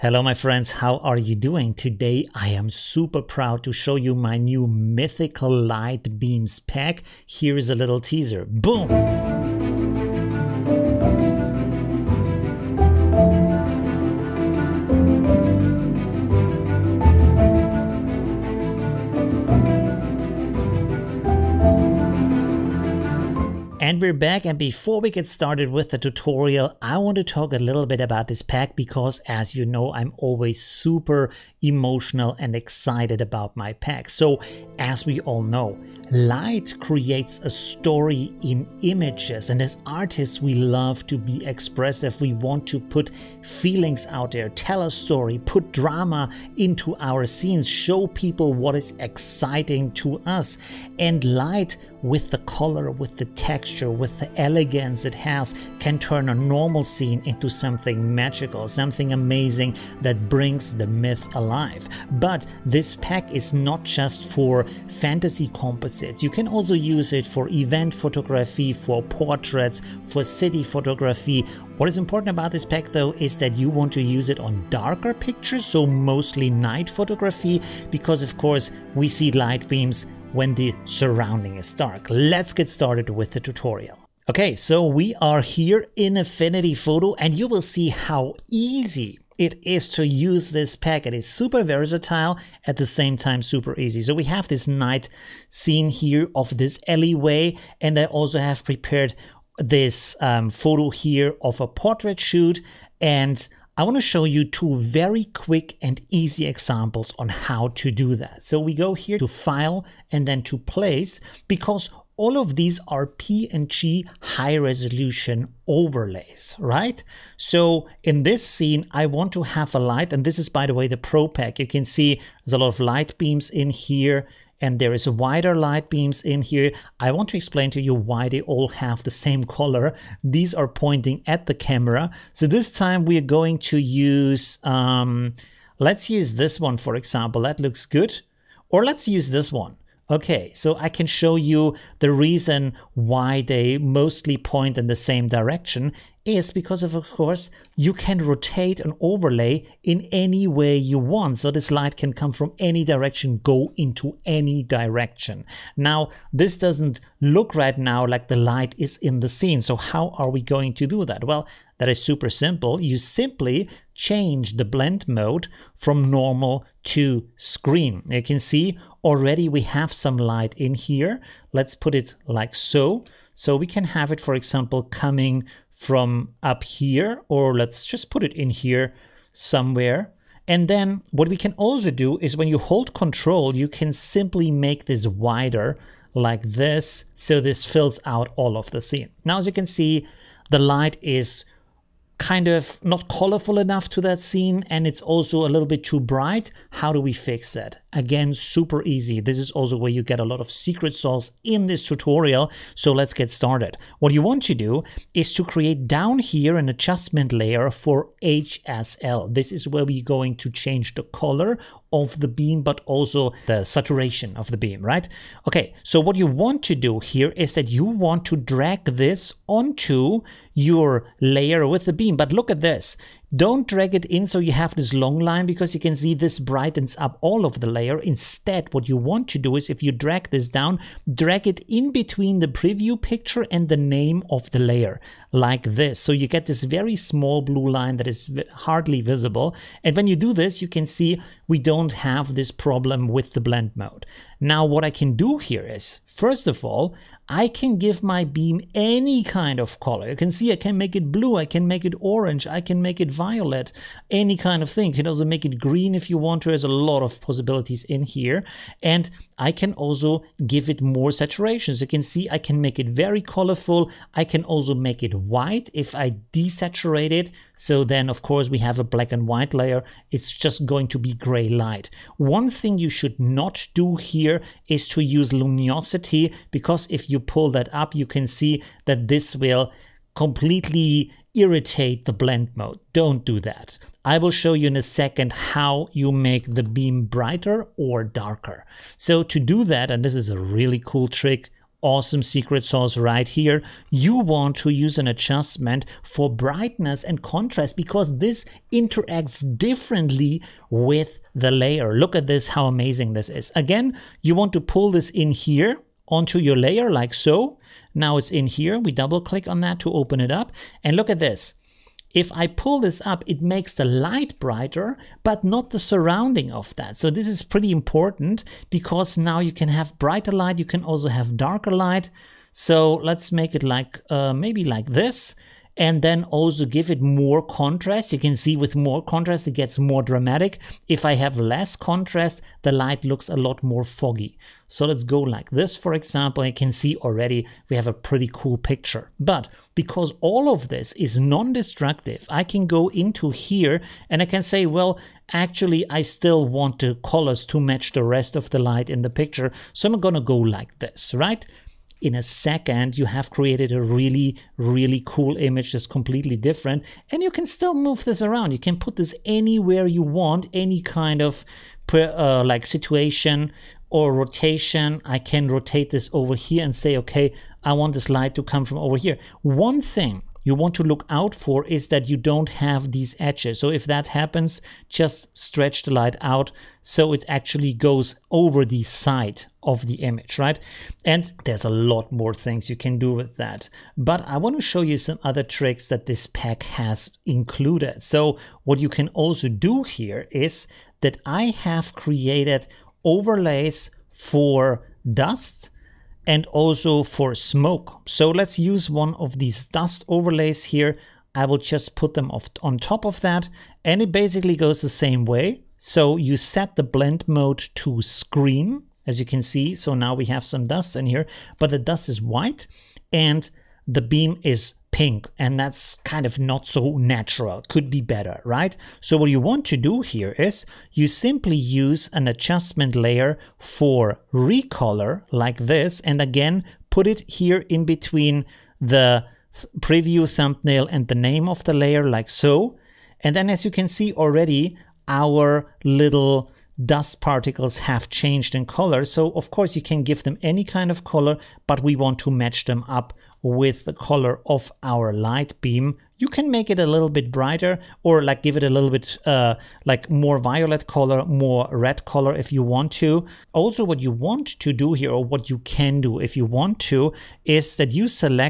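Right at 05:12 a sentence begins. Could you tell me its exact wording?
If I pull this up, it makes the light brighter, but not the surrounding of that.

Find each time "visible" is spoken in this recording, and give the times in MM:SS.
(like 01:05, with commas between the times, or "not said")
03:59.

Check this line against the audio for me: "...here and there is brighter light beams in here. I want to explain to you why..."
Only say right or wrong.
wrong.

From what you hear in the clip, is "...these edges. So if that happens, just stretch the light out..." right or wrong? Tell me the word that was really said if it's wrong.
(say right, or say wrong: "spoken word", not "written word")
right.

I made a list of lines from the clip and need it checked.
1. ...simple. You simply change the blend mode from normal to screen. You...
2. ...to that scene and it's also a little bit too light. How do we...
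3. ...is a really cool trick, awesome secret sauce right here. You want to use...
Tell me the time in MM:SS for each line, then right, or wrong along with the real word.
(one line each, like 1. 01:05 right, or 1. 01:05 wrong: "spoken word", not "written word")
1. 02:42 right
2. 03:13 wrong: "bright", not "light"
3. 04:50 right.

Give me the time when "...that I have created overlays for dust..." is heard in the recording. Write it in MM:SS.
06:31.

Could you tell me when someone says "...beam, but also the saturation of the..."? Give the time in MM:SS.
03:32.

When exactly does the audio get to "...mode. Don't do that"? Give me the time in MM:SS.
04:42.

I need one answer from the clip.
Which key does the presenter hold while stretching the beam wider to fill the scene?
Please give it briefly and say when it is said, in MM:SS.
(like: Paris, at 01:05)
Control, at 03:02.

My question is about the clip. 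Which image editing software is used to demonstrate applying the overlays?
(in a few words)
Affinity Photo.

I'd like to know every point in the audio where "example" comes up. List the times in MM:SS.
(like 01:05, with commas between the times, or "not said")
01:46, 02:16, 02:54, 05:35.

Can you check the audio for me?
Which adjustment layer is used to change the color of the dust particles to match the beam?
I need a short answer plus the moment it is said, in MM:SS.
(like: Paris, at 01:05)
Recolor, at 07:04.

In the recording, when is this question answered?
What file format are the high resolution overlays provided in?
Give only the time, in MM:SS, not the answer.
01:53.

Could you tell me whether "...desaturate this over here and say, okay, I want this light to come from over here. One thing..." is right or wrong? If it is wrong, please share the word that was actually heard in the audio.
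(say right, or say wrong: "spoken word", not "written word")
wrong: "rotate", not "desaturate".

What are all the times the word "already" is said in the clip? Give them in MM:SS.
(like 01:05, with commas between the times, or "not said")
02:49, 05:36, 07:14.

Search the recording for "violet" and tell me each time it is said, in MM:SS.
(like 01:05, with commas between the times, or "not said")
04:13, 07:30.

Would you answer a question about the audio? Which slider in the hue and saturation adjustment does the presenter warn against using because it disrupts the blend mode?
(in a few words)
Luminosity.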